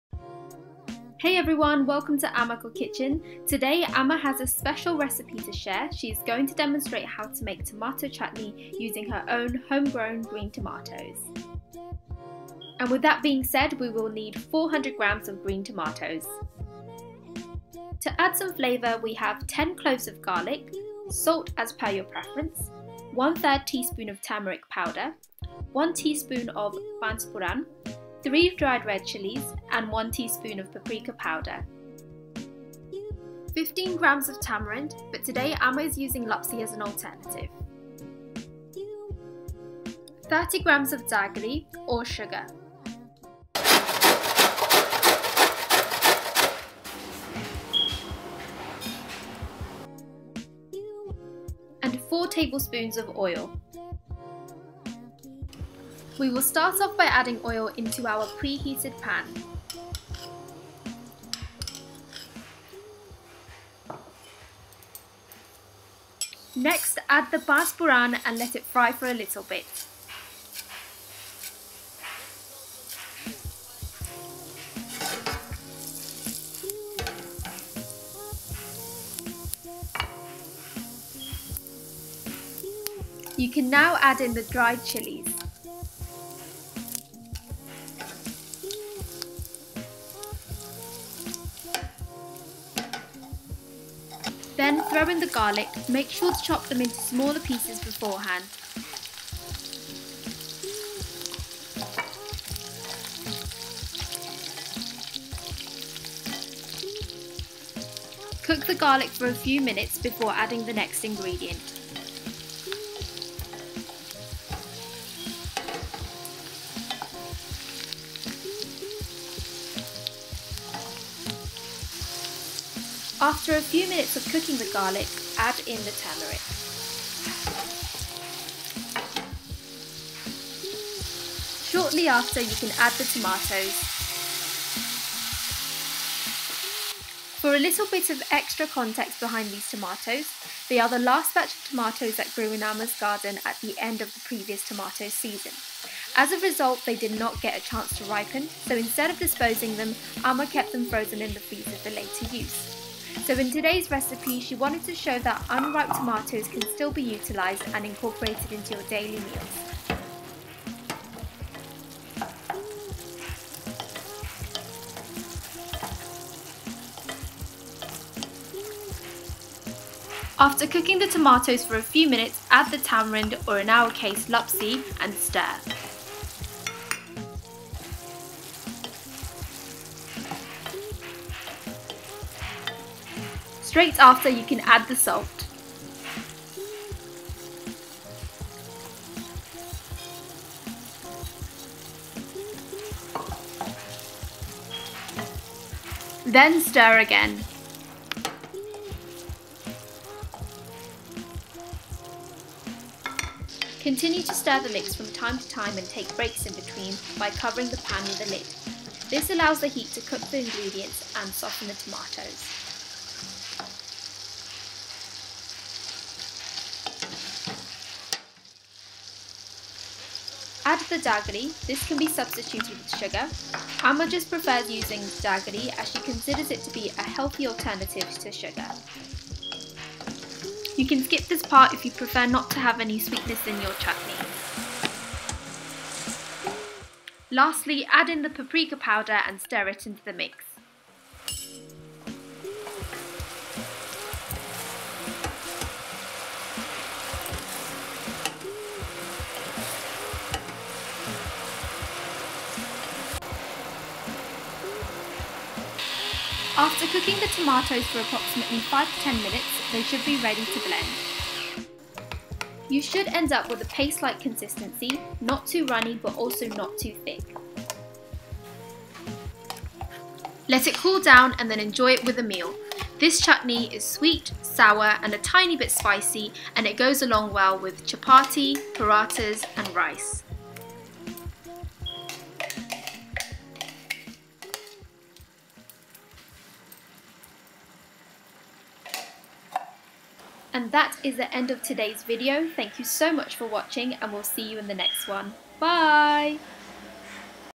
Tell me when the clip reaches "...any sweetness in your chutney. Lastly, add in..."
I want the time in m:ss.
3:52.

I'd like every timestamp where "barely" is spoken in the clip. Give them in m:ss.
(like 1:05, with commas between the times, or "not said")
not said.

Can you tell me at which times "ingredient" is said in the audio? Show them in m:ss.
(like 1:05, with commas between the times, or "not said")
1:51, 3:30.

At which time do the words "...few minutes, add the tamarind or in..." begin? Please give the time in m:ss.
2:51.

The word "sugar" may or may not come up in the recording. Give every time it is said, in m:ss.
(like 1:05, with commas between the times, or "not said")
0:42, 3:42, 3:48.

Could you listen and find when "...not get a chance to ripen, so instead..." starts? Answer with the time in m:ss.
2:27.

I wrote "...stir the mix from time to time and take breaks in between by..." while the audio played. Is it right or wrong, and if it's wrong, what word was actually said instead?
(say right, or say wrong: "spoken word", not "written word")
right.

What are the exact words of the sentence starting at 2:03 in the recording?
After a few minutes of cooking the garlic, add in the turmeric.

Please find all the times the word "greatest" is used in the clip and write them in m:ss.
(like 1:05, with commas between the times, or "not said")
not said.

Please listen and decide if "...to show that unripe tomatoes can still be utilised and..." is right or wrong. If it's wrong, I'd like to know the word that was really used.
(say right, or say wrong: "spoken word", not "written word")
right.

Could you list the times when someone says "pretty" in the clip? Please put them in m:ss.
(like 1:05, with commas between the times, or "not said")
not said.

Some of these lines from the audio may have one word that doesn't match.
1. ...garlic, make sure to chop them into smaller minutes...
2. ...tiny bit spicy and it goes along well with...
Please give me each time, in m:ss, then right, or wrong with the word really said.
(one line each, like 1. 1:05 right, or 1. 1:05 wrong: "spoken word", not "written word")
1. 1:35 wrong: "pieces", not "minutes"
2. 4:35 right.